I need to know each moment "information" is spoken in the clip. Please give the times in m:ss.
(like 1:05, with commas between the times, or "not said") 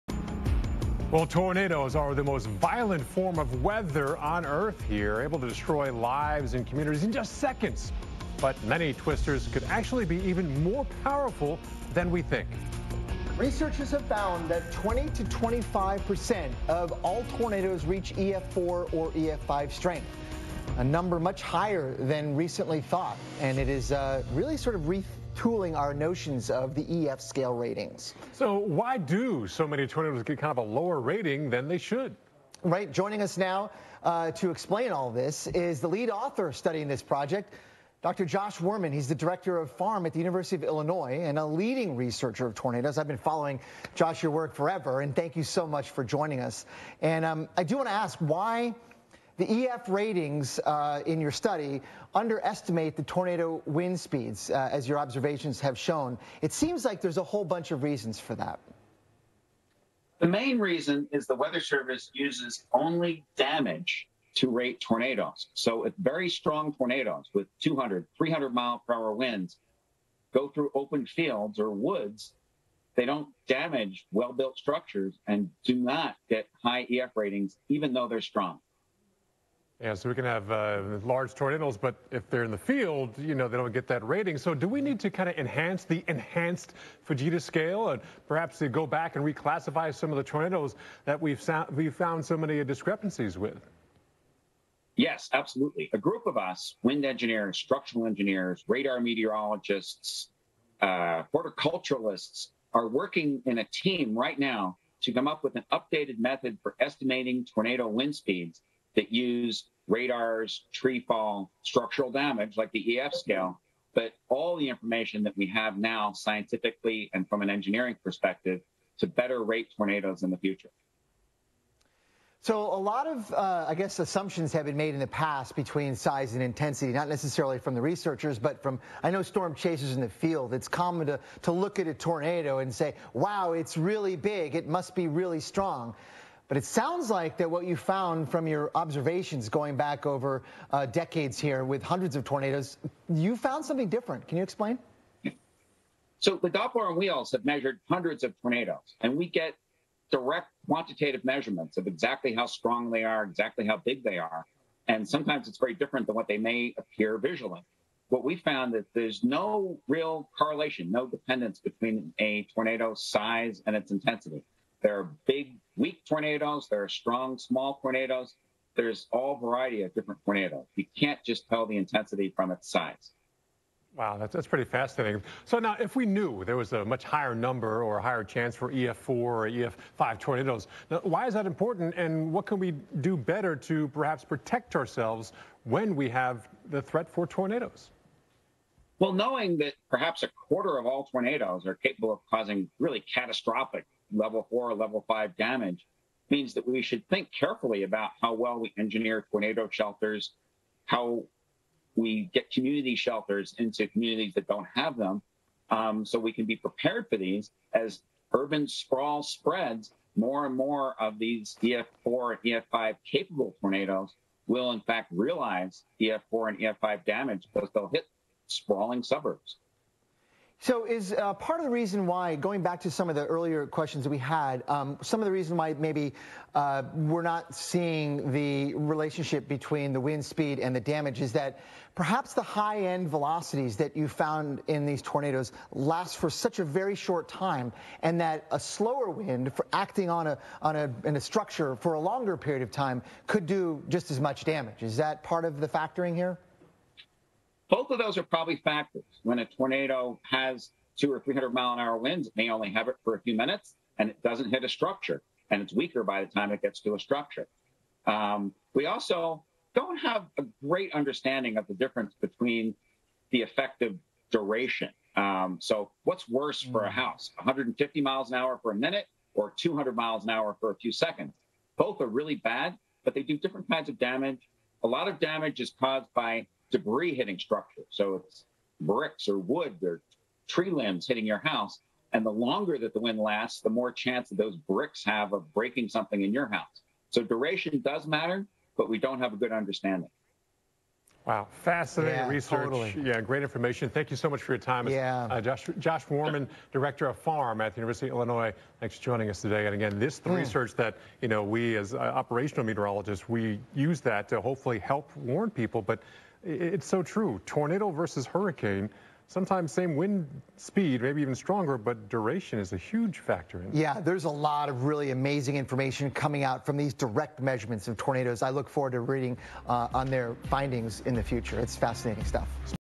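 1:54, 4:53, 5:15.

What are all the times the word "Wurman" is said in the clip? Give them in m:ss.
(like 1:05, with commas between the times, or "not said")
0:38, 4:56.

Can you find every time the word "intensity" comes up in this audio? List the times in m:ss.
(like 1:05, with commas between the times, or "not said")
2:06, 2:43, 2:51.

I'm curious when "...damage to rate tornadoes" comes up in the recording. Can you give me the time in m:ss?
1:03.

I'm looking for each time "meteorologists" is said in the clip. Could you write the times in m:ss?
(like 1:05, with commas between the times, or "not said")
1:38, 5:02.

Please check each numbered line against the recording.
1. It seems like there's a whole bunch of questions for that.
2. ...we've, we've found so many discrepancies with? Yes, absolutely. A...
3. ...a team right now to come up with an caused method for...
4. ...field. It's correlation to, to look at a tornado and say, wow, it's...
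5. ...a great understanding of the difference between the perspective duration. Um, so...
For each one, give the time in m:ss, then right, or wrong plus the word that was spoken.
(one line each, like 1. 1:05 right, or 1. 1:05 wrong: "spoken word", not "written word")
1. 0:56 wrong: "reasons", not "questions"
2. 1:31 right
3. 1:43 wrong: "updated", not "caused"
4. 2:10 wrong: "common", not "correlation"
5. 4:20 wrong: "effective", not "perspective".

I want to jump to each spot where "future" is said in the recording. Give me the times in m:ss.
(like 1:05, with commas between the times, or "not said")
2:00, 5:21.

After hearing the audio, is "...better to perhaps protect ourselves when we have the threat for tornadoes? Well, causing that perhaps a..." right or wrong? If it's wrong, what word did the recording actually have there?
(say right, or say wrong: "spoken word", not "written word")
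wrong: "knowing", not "causing".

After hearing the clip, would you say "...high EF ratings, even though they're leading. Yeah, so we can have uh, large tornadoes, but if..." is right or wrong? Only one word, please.
wrong.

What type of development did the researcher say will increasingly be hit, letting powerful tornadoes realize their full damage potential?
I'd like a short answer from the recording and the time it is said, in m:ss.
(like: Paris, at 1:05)
sprawling suburbs, at 3:38.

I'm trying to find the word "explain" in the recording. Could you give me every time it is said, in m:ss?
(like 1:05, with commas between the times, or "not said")
0:34, 2:24.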